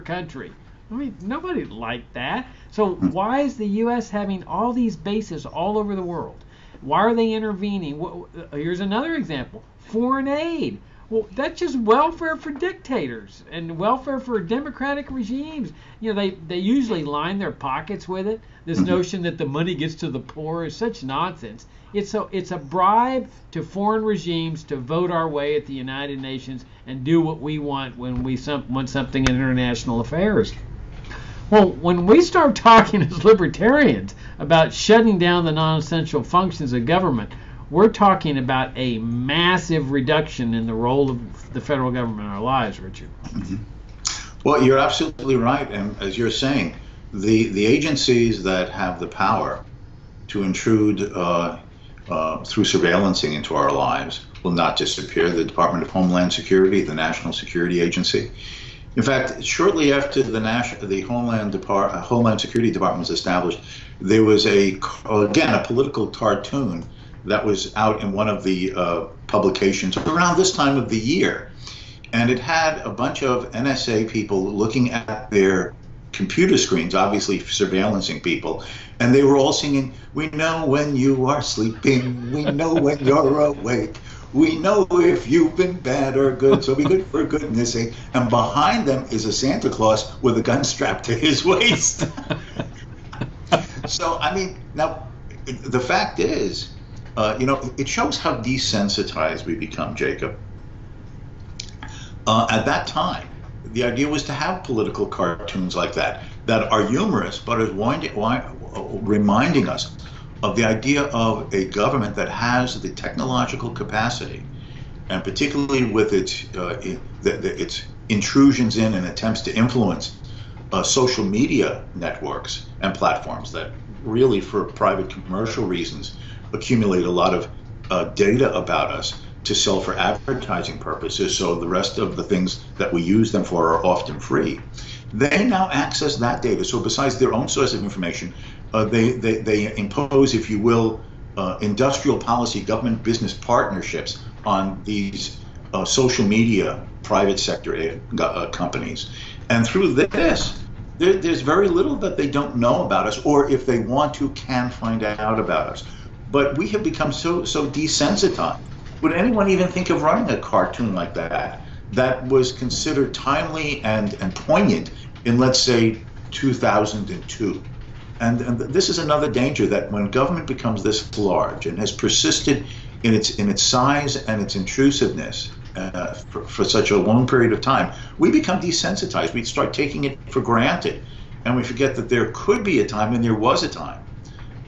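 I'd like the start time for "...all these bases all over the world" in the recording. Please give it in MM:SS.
00:04.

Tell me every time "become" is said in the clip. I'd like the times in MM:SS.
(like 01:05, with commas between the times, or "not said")
01:39, 02:36, 02:50, 02:58.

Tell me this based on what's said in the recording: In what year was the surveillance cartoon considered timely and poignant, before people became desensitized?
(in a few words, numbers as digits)
2002.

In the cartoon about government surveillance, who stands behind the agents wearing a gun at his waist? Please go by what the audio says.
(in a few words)
Santa Claus.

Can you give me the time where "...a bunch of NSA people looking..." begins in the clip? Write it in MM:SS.
01:12.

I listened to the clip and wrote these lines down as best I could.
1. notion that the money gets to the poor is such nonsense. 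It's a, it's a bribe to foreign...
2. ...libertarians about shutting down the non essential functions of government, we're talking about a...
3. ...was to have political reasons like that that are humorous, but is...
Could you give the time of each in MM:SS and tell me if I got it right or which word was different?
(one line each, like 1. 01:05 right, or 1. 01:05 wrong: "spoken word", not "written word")
1. 00:18 right
2. 00:33 right
3. 01:44 wrong: "cartoons", not "reasons".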